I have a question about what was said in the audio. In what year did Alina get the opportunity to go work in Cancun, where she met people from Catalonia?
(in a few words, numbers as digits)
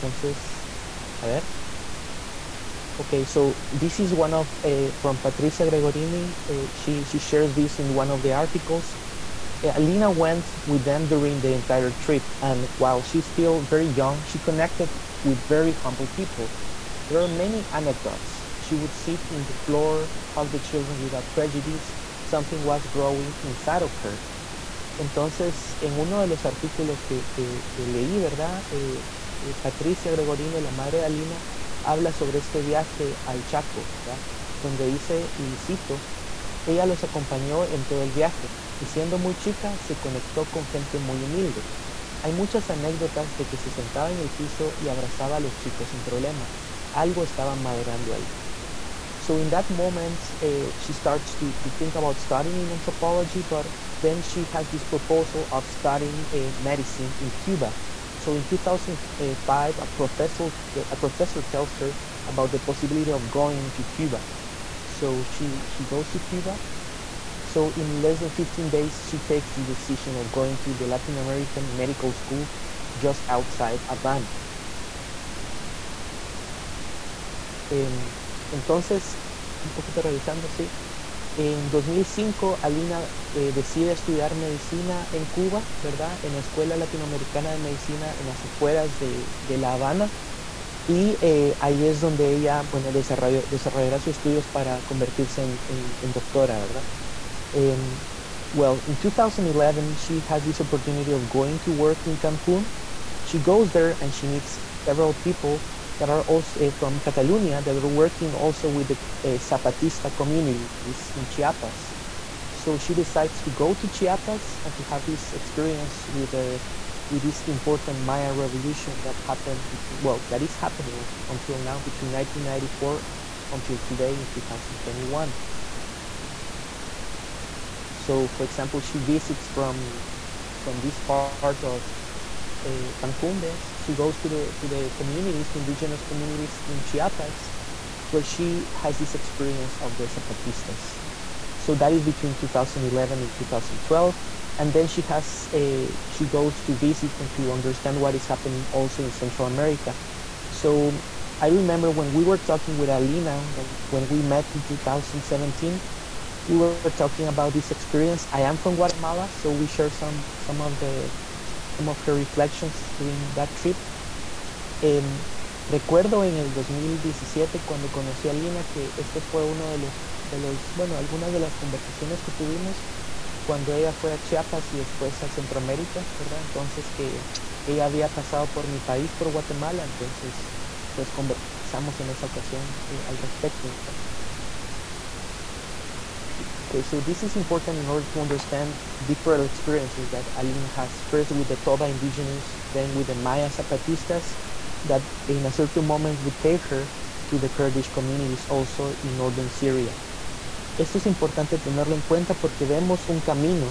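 2011.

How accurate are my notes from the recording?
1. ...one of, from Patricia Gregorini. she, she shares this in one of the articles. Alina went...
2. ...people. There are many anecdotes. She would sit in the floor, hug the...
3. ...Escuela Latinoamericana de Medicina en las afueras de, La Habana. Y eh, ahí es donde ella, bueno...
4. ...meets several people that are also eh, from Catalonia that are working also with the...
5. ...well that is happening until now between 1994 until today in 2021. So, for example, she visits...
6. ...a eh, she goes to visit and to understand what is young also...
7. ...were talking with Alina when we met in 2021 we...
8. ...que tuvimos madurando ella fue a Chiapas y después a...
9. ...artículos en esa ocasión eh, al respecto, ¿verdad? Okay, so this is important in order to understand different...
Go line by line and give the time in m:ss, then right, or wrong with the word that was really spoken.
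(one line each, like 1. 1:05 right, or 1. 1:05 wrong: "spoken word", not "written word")
1. 0:04 right
2. 0:16 right
3. 1:26 right
4. 1:44 right
5. 2:00 right
6. 2:25 wrong: "happening", not "young"
7. 2:32 wrong: "2017", not "2021"
8. 2:52 wrong: "cuando", not "madurando"
9. 3:01 wrong: "conversamos", not "artículos".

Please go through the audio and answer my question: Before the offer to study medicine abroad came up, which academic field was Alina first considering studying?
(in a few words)
anthropology.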